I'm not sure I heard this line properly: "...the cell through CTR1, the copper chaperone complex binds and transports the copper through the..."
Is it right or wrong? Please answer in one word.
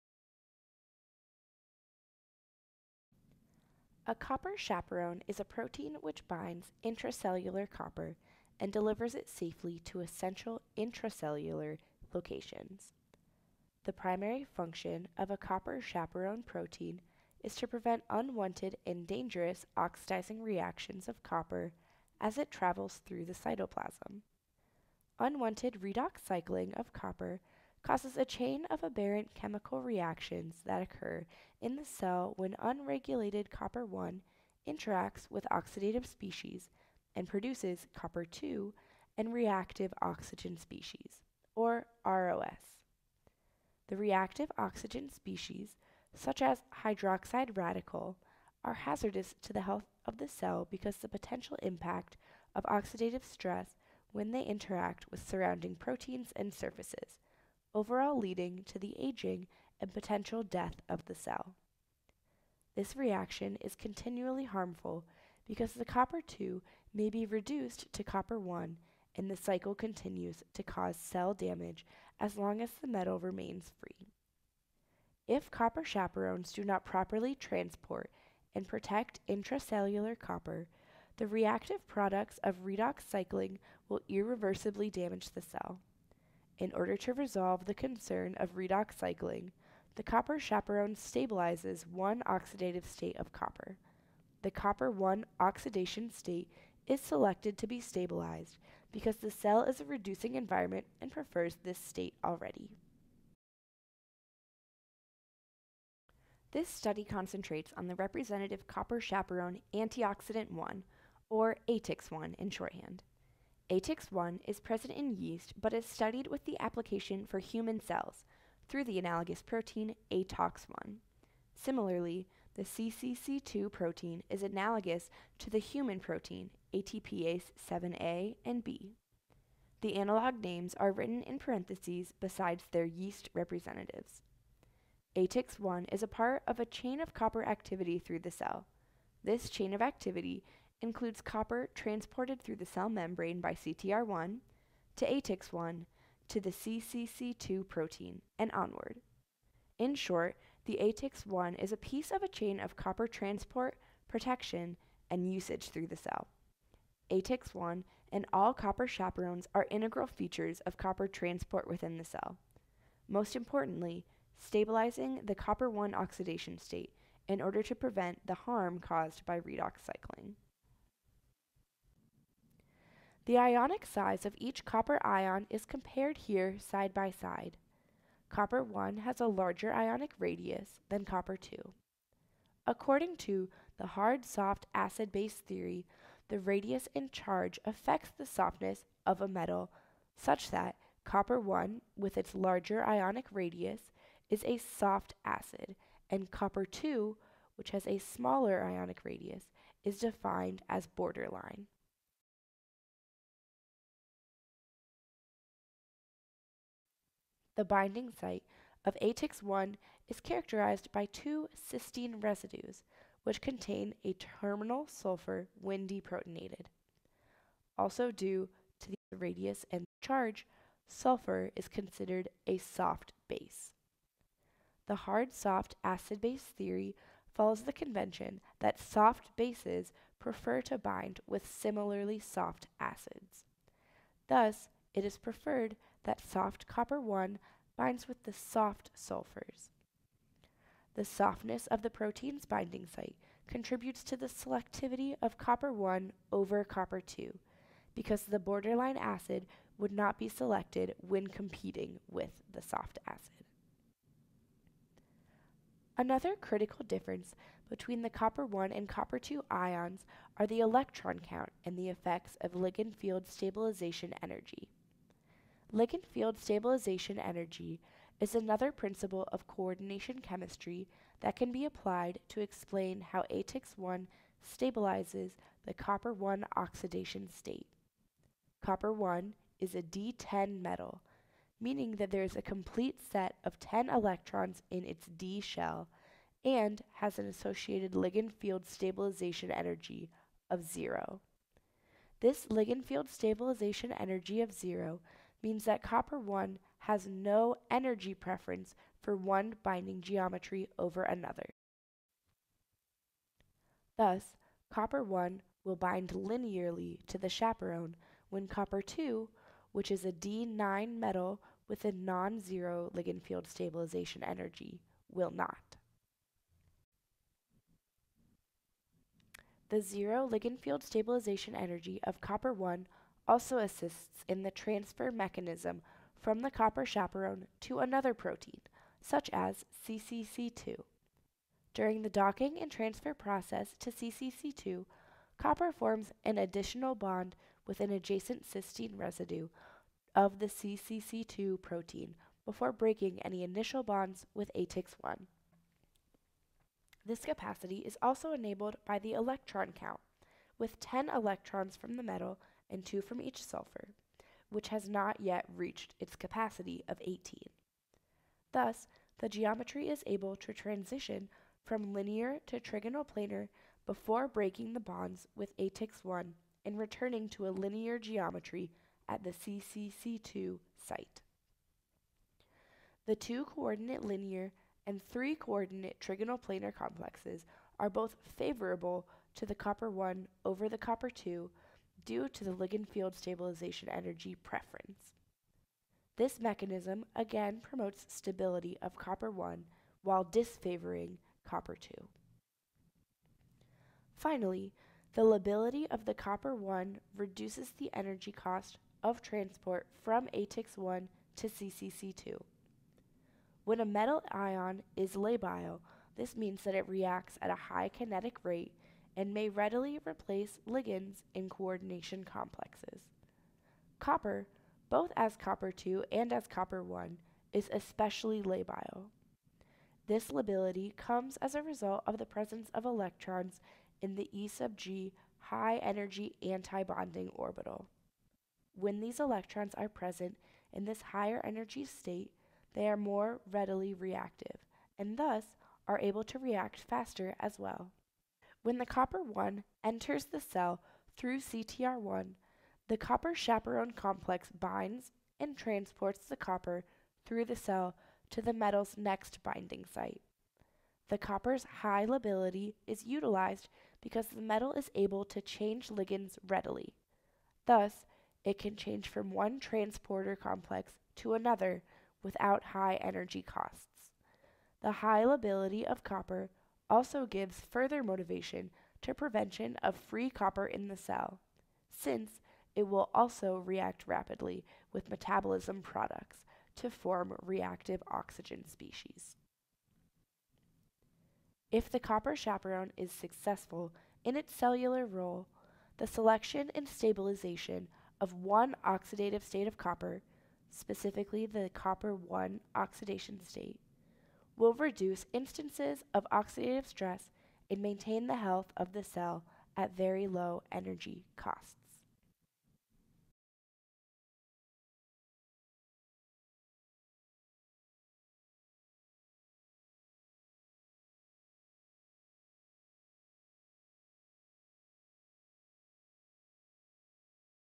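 right.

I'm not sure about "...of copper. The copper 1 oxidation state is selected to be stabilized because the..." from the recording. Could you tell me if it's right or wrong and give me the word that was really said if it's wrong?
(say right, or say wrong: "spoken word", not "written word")
right.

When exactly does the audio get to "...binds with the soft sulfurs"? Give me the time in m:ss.
3:57.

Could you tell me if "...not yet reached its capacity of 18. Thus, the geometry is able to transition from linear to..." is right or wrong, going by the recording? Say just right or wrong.
right.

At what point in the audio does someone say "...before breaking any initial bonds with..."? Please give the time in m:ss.
5:42.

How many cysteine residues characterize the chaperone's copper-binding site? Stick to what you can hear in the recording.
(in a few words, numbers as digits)
2.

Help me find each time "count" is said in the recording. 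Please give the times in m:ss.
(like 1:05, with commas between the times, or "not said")
4:21, 5:49.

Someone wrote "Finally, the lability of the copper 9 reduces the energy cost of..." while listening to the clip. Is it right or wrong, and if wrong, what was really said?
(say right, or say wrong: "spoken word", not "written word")
wrong: "1", not "9".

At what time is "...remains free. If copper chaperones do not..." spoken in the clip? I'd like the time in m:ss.
1:13.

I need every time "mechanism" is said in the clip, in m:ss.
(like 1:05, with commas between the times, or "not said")
5:25, 6:26.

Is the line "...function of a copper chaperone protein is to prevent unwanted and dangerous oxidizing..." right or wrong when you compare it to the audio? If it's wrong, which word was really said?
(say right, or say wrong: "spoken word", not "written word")
right.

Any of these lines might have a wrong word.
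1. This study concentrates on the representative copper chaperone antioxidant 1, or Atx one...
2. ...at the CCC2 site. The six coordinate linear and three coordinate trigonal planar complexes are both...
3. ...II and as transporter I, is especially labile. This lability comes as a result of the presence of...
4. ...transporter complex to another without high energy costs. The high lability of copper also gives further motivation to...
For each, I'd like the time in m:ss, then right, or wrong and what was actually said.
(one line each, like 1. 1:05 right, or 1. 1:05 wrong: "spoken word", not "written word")
1. 1:46 right
2. 6:09 wrong: "two", not "six"
3. 6:55 wrong: "copper", not "transporter"
4. 7:39 right.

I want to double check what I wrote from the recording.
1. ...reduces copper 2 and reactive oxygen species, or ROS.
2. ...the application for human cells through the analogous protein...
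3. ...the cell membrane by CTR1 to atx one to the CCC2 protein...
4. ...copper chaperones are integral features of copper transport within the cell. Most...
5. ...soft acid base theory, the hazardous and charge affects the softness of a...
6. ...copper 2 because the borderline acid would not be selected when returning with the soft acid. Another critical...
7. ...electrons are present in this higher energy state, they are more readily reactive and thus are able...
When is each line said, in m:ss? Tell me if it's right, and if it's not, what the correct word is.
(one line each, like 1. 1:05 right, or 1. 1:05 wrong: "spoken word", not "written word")
1. 0:37 wrong: "produces", not "reduces"
2. 1:56 right
3. 2:22 right
4. 2:38 right
5. 3:04 wrong: "radius", not "hazardous"
6. 4:06 wrong: "competing", not "returning"
7. 7:09 right.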